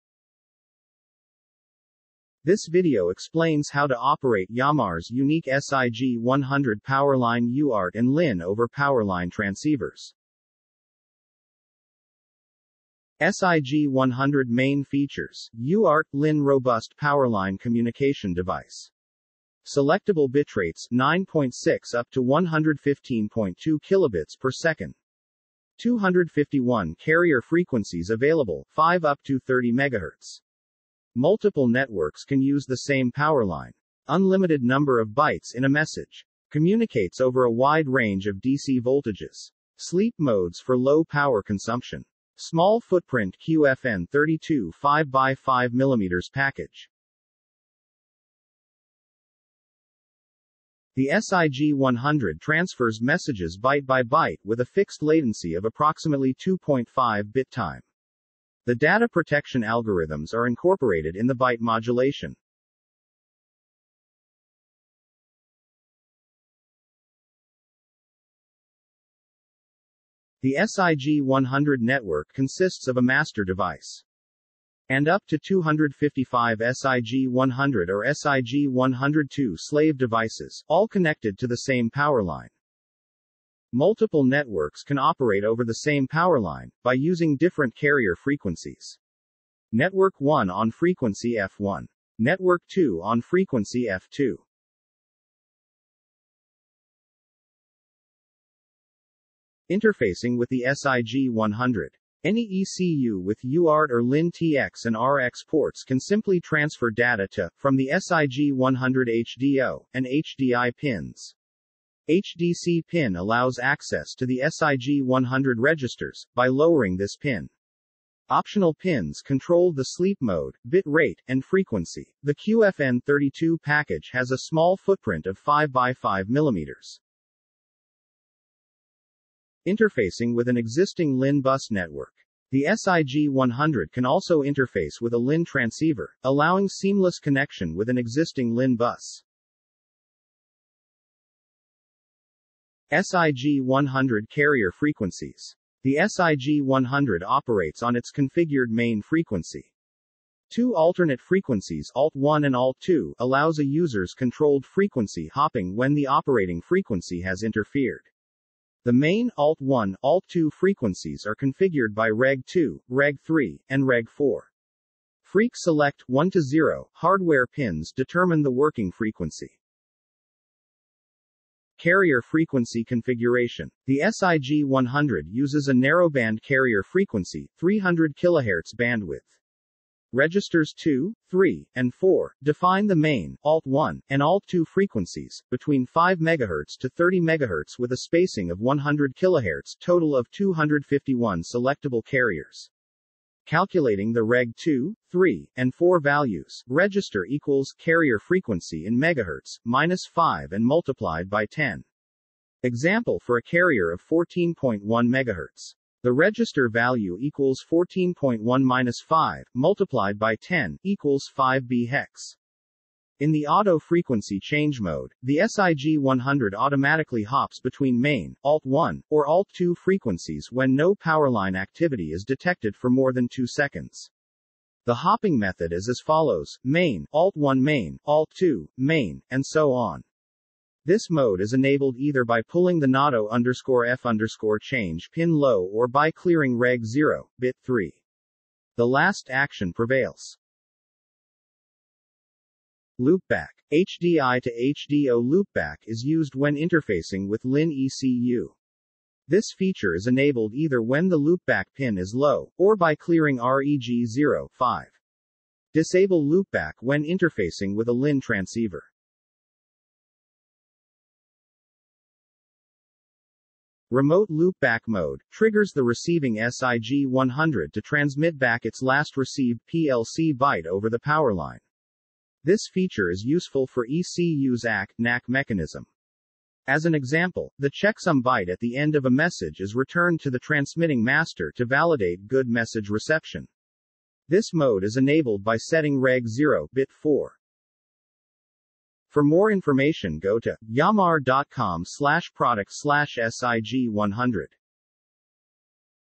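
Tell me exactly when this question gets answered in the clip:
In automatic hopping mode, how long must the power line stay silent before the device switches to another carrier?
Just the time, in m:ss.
3:43.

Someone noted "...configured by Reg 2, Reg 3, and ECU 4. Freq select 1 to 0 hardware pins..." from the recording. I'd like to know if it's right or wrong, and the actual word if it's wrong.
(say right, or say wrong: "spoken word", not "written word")
wrong: "Reg", not "ECU".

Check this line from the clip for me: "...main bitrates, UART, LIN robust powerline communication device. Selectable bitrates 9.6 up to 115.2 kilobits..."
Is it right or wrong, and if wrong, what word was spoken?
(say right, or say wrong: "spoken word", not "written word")
wrong: "features", not "bitrates".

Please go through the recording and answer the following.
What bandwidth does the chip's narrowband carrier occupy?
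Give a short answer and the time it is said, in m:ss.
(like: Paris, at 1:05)
300 kHz, at 2:57.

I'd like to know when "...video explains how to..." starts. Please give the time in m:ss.
0:02.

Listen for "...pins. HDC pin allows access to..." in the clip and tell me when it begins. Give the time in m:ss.
1:50.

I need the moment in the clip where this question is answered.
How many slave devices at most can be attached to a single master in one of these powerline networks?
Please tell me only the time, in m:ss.
1:15.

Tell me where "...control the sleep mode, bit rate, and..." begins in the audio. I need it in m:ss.
1:59.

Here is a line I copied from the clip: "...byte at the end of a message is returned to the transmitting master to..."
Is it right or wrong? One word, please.
right.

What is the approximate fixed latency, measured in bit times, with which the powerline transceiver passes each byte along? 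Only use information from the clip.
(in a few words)
2.5 bit time.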